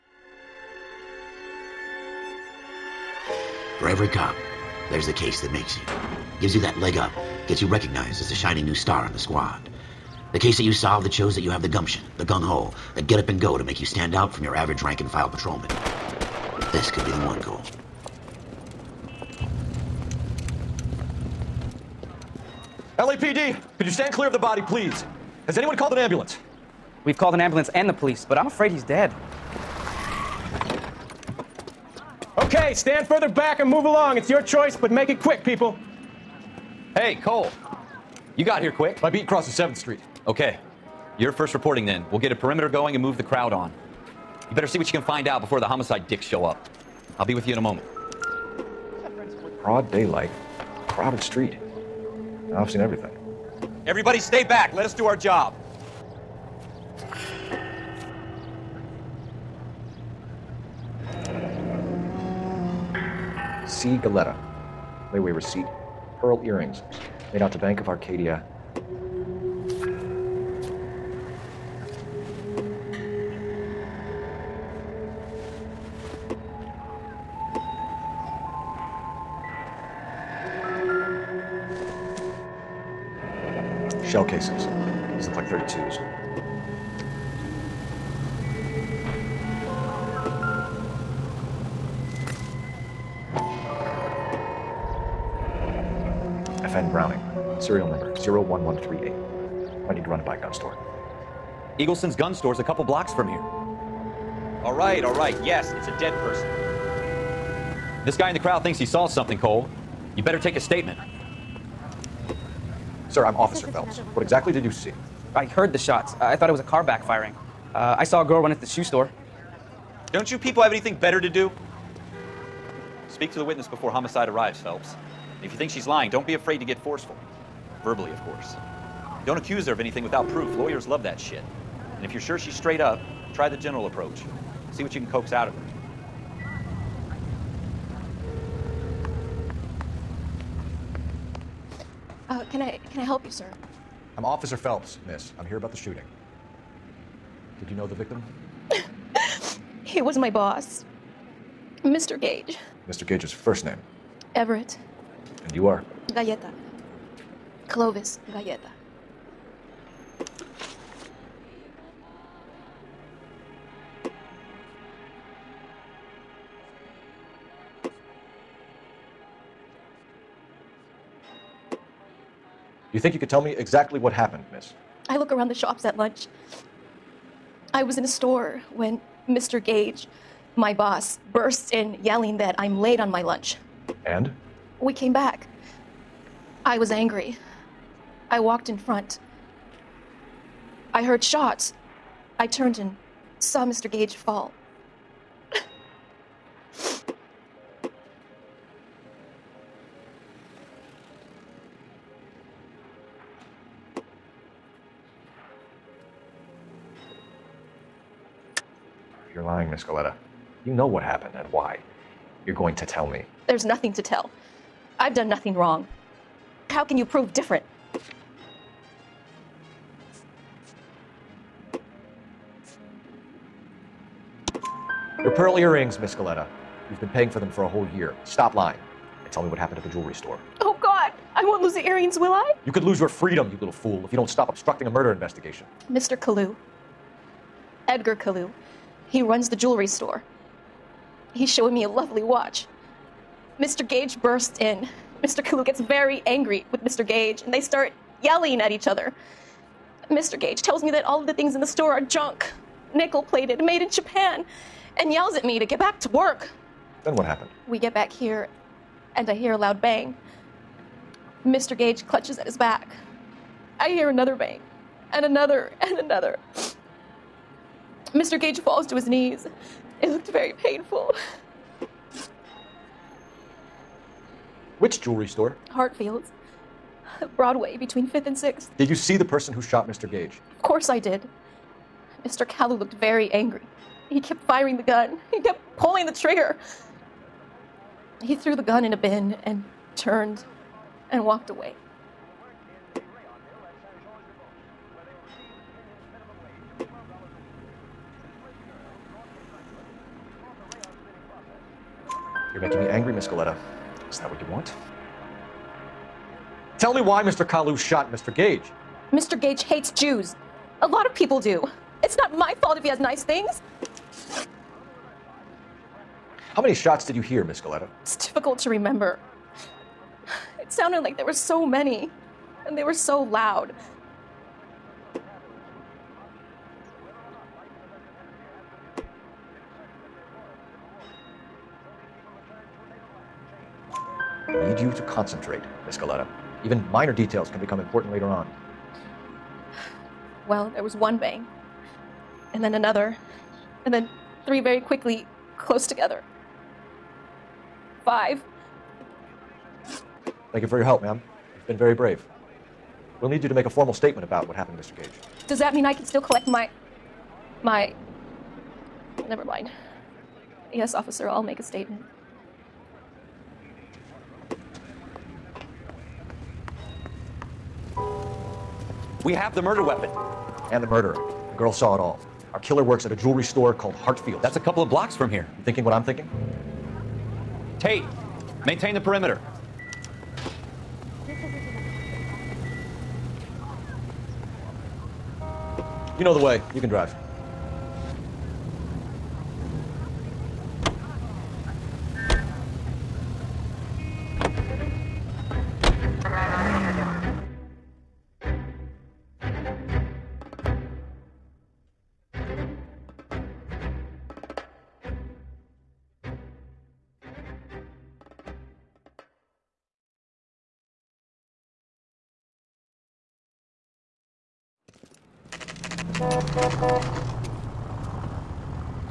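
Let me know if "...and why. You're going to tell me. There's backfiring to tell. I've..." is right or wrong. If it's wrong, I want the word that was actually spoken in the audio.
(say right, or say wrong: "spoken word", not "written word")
wrong: "nothing", not "backfiring".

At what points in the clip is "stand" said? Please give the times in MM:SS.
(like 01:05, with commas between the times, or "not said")
00:13, 00:23, 00:32.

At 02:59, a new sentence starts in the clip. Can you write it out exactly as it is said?
Gage, my boss, bursts in yelling that I'm late on my lunch.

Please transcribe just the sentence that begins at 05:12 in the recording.
It's not my fault if he has nice things.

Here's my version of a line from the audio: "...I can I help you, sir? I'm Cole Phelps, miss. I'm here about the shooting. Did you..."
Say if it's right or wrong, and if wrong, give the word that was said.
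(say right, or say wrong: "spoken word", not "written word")
wrong: "Officer", not "Cole".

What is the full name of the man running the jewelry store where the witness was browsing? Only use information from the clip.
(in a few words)
Edgar Kalou.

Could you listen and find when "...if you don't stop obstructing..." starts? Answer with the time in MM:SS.
03:54.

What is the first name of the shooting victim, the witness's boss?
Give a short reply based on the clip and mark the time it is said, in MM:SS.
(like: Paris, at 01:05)
Everett, at 02:34.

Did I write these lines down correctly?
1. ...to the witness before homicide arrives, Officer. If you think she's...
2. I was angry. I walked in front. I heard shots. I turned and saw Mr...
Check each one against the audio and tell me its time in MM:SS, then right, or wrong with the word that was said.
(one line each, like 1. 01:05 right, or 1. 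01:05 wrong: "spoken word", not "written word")
1. 02:03 wrong: "Phelps", not "Officer"
2. 03:06 right.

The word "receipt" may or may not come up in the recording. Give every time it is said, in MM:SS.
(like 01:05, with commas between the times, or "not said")
01:05.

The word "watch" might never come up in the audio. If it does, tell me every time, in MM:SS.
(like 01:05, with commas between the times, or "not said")
04:02.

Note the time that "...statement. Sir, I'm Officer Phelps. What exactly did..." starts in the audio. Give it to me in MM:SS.
01:50.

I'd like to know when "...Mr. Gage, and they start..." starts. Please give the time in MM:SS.
04:06.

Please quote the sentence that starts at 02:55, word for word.
I look around the shops at lunch.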